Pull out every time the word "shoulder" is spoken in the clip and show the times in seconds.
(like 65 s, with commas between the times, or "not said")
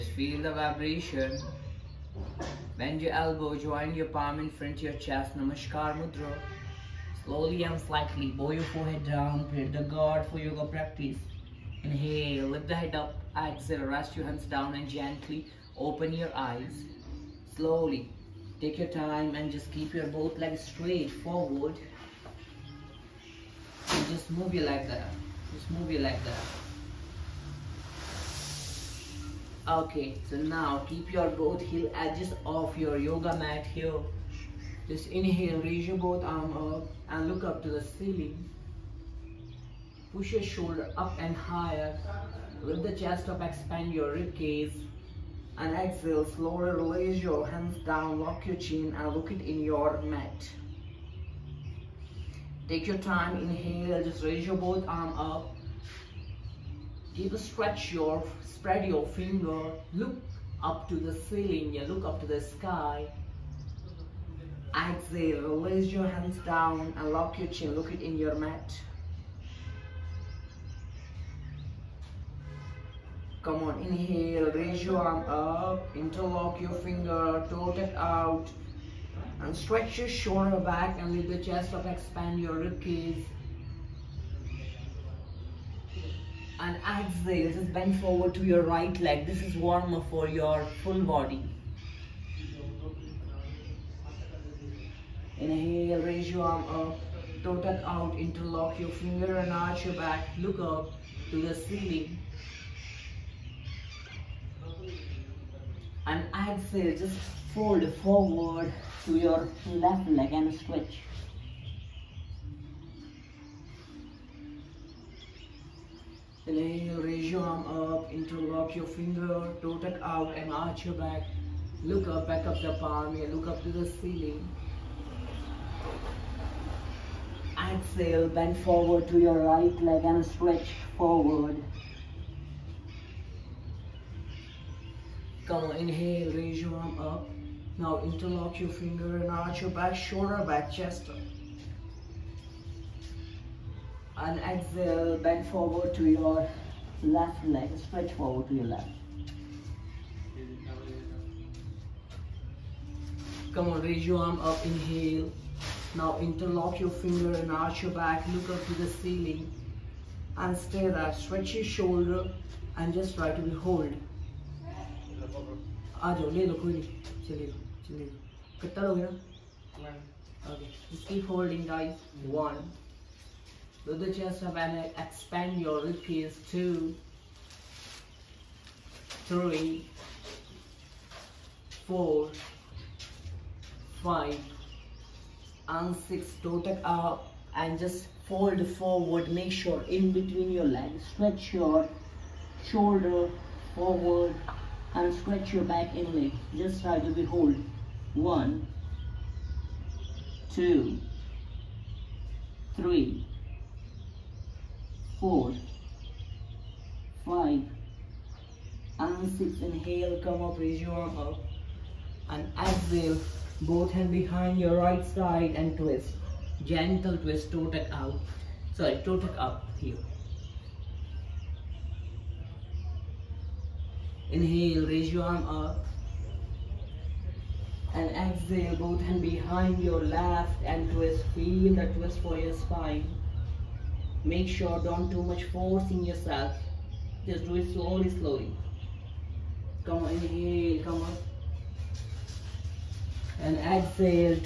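40 s, 80 s, 139 s, 161 s, 192 s.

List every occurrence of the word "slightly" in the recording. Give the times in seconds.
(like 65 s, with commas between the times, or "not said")
7 s.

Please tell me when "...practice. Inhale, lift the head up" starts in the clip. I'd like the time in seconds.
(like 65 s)
10 s.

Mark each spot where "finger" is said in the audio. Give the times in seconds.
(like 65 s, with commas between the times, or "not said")
59 s, 76 s, 98 s, 118 s, 138 s, 157 s.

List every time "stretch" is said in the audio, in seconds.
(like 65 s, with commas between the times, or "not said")
57 s, 79 s, 110 s, 130 s, 147 s, 161 s, 191 s, 195 s.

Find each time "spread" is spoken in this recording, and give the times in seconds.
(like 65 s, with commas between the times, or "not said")
58 s.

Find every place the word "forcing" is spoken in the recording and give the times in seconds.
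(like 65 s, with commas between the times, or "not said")
235 s.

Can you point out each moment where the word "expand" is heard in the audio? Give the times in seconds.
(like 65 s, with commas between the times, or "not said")
43 s, 81 s, 175 s.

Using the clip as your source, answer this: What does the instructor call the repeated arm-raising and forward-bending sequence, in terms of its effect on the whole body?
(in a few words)
warmer.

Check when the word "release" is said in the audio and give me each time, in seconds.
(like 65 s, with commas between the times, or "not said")
46 s, 65 s.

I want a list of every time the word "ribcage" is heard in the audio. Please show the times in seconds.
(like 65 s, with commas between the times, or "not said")
82 s, 175 s.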